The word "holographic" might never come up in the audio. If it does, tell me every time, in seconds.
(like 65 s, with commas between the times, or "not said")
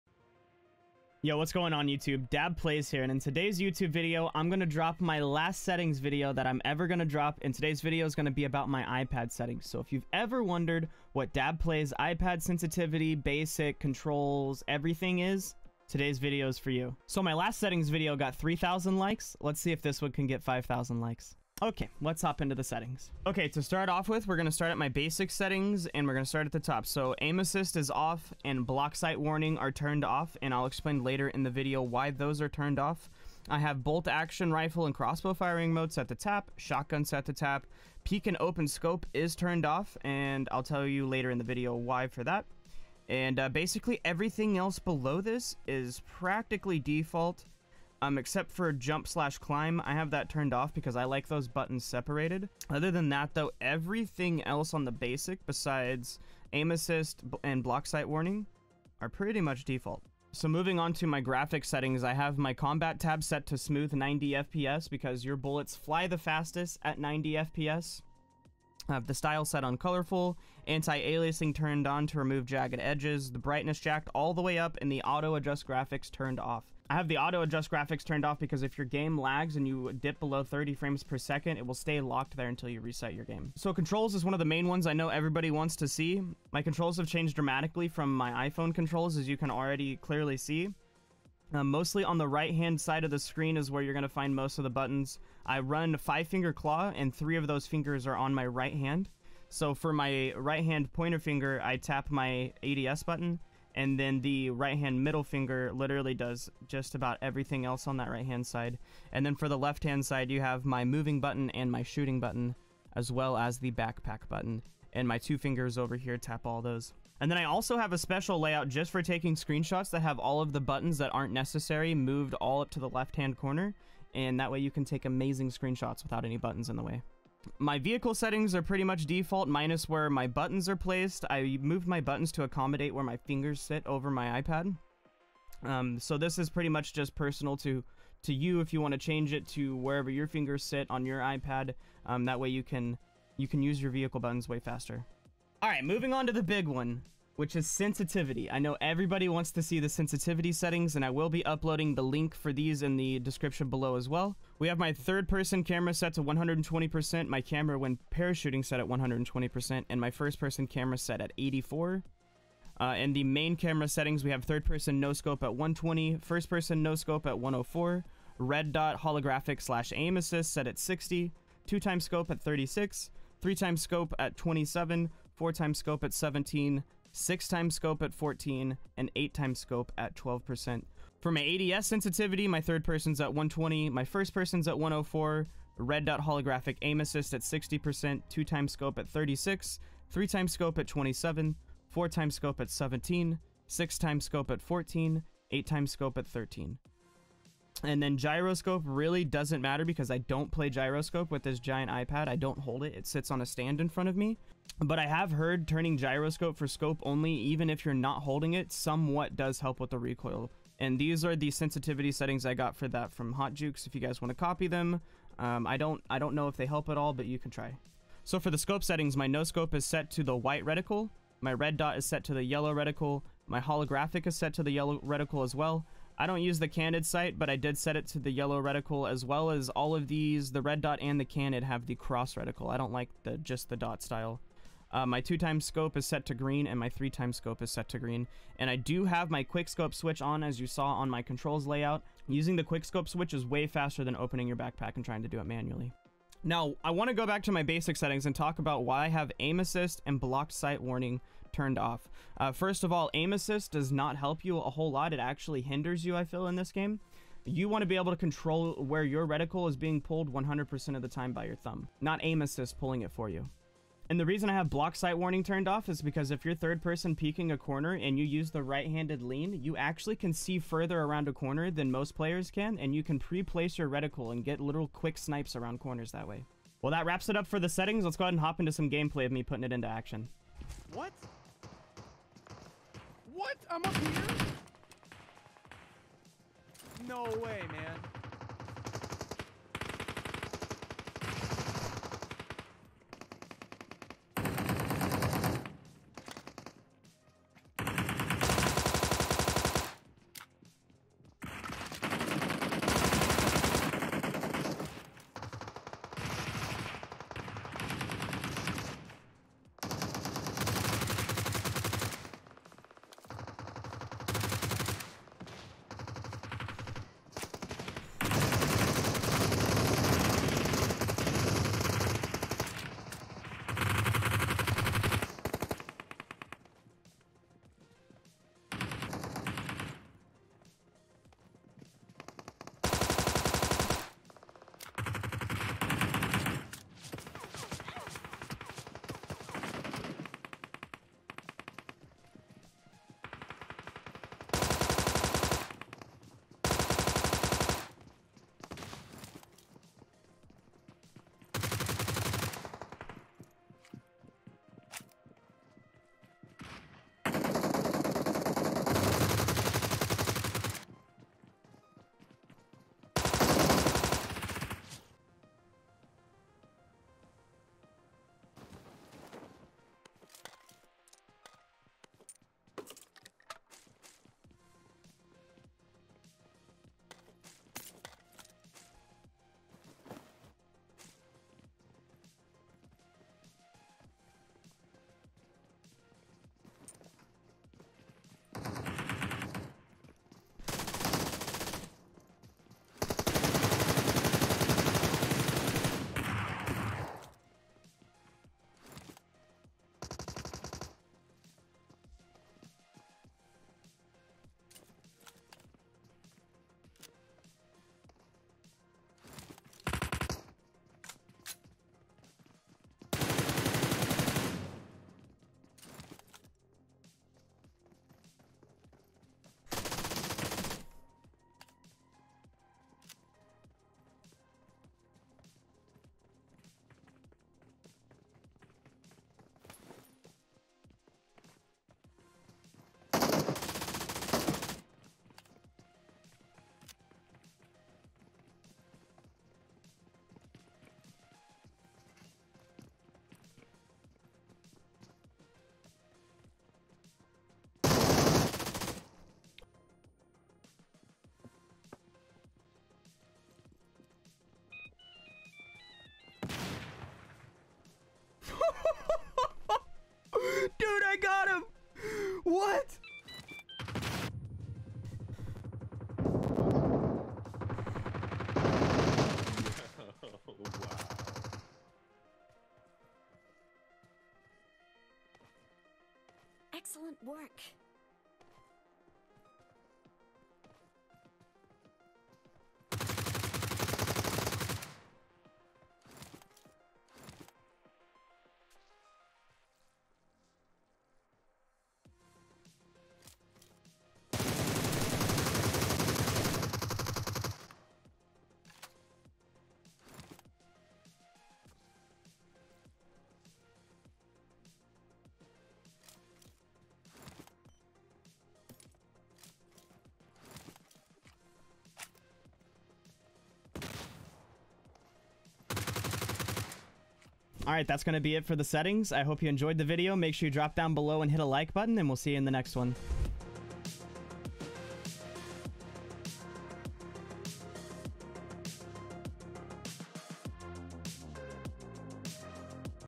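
169 s, 186 s, 223 s.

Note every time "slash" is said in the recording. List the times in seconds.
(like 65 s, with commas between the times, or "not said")
49 s, 169 s.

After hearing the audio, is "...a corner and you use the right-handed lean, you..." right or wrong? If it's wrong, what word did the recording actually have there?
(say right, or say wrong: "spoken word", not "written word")
right.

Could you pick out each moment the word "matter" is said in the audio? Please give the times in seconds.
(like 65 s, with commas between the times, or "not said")
199 s.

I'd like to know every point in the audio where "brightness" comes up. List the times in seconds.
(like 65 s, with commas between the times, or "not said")
73 s.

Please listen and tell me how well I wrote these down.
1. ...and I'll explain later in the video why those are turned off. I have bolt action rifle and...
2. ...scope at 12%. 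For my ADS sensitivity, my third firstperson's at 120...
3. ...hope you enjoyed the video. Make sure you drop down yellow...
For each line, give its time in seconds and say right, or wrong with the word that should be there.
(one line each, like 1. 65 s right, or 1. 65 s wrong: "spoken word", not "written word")
1. 30 s right
2. 179 s wrong: "person", not "firstperson"
3. 519 s wrong: "below", not "yellow".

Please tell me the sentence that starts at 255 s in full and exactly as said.
It actually hinders you, I feel, in this game.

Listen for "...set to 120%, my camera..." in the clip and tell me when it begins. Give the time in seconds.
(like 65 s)
155 s.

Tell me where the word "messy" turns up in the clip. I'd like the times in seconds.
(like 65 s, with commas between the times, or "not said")
not said.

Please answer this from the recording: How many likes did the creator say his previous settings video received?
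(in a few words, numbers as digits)
3,000.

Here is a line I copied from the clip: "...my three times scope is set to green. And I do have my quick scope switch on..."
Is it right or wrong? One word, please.
right.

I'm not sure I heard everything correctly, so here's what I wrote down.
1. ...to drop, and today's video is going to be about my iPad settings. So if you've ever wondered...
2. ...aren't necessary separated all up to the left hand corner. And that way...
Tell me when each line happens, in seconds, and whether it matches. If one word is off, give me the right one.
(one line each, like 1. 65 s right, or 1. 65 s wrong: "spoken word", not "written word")
1. 6 s right
2. 121 s wrong: "moved", not "separated".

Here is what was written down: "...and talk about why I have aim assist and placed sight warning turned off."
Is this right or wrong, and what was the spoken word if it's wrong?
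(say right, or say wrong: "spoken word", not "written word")
wrong: "blocked", not "placed".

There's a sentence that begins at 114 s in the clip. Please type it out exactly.
And my two fingers over here tap all those.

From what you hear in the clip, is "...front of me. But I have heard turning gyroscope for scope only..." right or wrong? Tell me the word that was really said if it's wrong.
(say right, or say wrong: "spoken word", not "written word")
right.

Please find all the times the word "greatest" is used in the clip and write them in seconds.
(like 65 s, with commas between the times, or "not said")
not said.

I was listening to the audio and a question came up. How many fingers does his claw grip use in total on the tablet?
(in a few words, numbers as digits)
5.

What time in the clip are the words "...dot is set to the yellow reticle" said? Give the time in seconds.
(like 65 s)
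221 s.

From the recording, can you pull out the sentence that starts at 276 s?
Well, that wraps it up for the settings.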